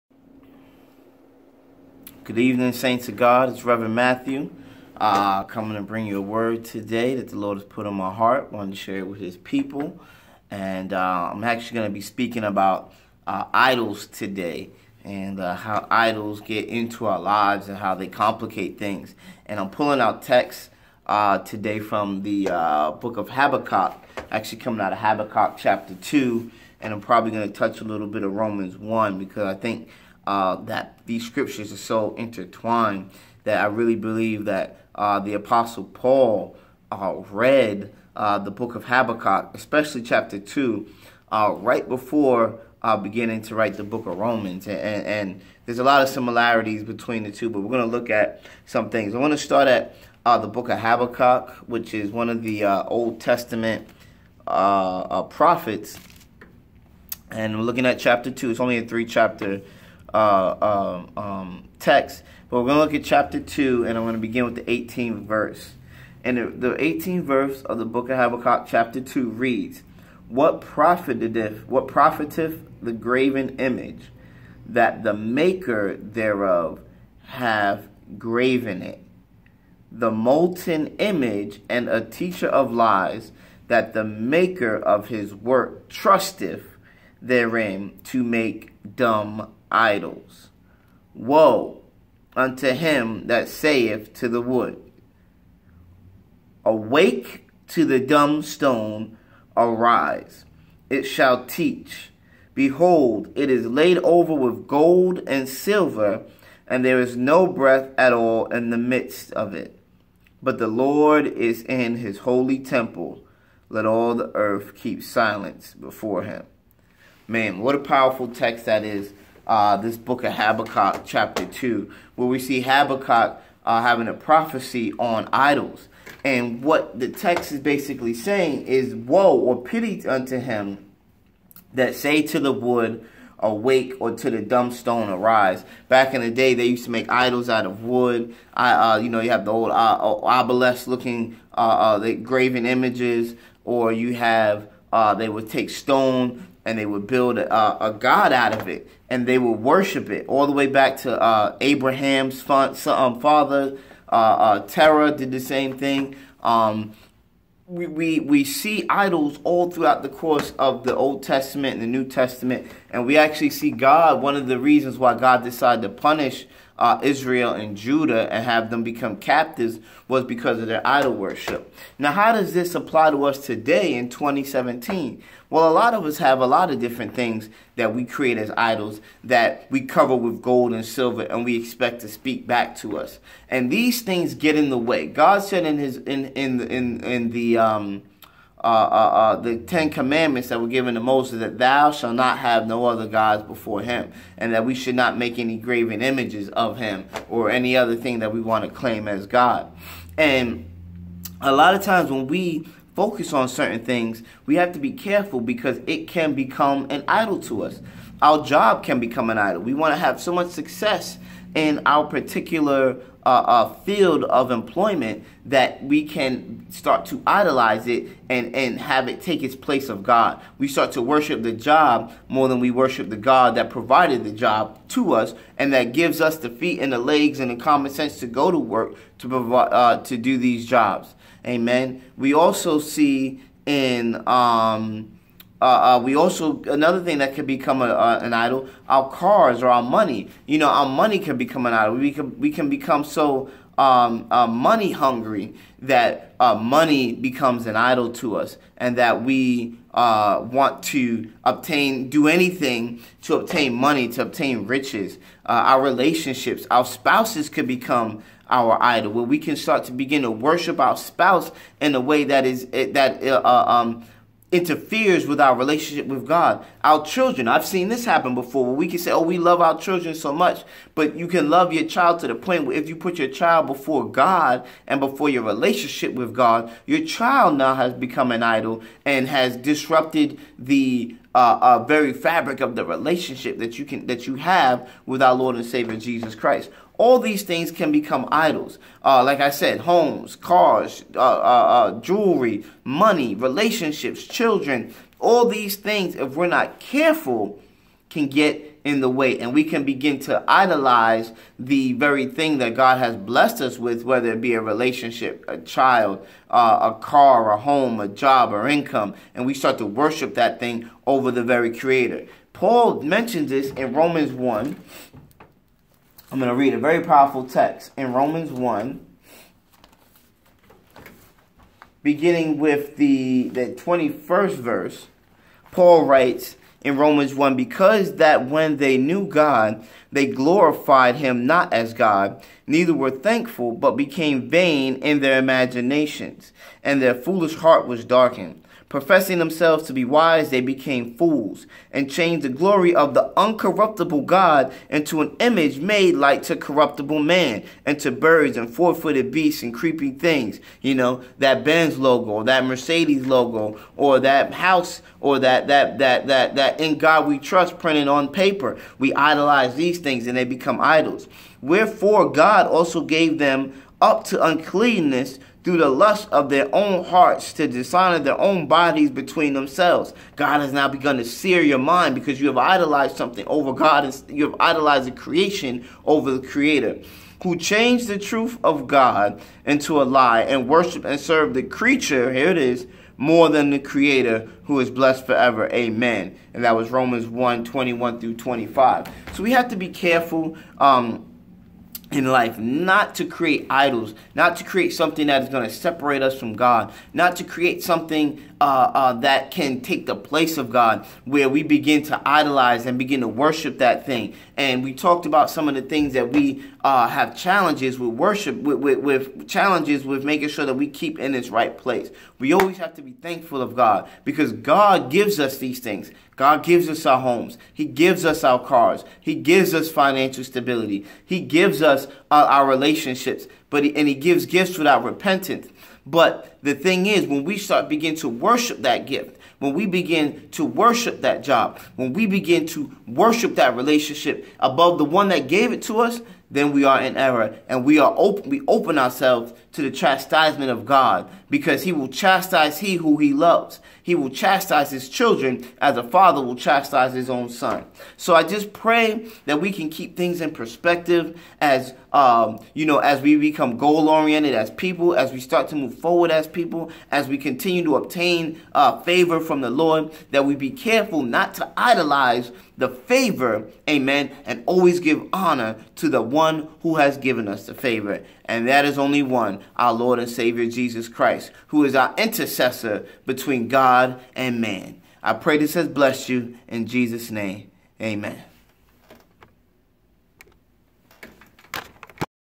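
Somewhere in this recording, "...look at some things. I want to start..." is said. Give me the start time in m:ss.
0:47.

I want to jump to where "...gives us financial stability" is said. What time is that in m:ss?
6:59.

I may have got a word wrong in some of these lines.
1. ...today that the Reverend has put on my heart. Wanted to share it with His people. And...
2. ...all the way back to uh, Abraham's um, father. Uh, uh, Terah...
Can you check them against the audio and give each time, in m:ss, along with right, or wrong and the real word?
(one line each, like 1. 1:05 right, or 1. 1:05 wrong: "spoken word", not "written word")
1. 0:06 wrong: "Lord", not "Reverend"
2. 2:30 right.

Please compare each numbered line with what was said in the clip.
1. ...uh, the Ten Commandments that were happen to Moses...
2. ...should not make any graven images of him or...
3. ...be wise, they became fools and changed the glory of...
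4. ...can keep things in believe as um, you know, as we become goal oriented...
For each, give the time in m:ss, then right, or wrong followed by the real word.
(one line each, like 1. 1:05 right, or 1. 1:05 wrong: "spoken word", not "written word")
1. 3:08 wrong: "given", not "happen"
2. 3:14 right
3. 5:39 right
4. 7:29 wrong: "perspective", not "believe".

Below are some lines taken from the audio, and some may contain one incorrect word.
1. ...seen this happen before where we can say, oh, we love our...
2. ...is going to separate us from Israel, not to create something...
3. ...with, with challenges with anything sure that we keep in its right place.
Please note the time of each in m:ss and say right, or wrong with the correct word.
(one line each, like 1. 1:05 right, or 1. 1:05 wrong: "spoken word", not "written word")
1. 4:27 right
2. 6:35 wrong: "God", not "Israel"
3. 6:48 wrong: "making", not "anything".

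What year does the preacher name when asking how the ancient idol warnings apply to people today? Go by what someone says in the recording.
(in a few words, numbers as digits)
2017.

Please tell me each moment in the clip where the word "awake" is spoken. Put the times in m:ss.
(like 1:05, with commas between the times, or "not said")
1:36, 2:13.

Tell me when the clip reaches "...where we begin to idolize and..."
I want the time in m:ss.
6:41.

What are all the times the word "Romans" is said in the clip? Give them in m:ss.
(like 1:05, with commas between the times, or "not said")
0:28, 0:44, 5:13, 5:18, 5:26, 6:26.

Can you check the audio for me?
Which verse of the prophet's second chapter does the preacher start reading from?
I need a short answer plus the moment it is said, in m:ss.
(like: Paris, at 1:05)
18th verse, at 1:04.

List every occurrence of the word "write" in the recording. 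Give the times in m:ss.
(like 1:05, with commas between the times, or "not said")
0:43, 5:26.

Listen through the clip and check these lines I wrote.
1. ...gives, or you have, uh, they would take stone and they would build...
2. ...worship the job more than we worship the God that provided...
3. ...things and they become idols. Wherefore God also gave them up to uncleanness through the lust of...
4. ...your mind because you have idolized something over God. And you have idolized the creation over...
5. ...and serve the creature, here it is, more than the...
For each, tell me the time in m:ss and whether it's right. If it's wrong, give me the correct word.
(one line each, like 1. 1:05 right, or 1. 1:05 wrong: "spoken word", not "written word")
1. 2:22 wrong: "images", not "gives"
2. 3:41 right
3. 5:59 right
4. 6:11 right
5. 6:21 right.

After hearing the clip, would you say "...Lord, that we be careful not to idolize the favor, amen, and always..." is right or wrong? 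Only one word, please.
right.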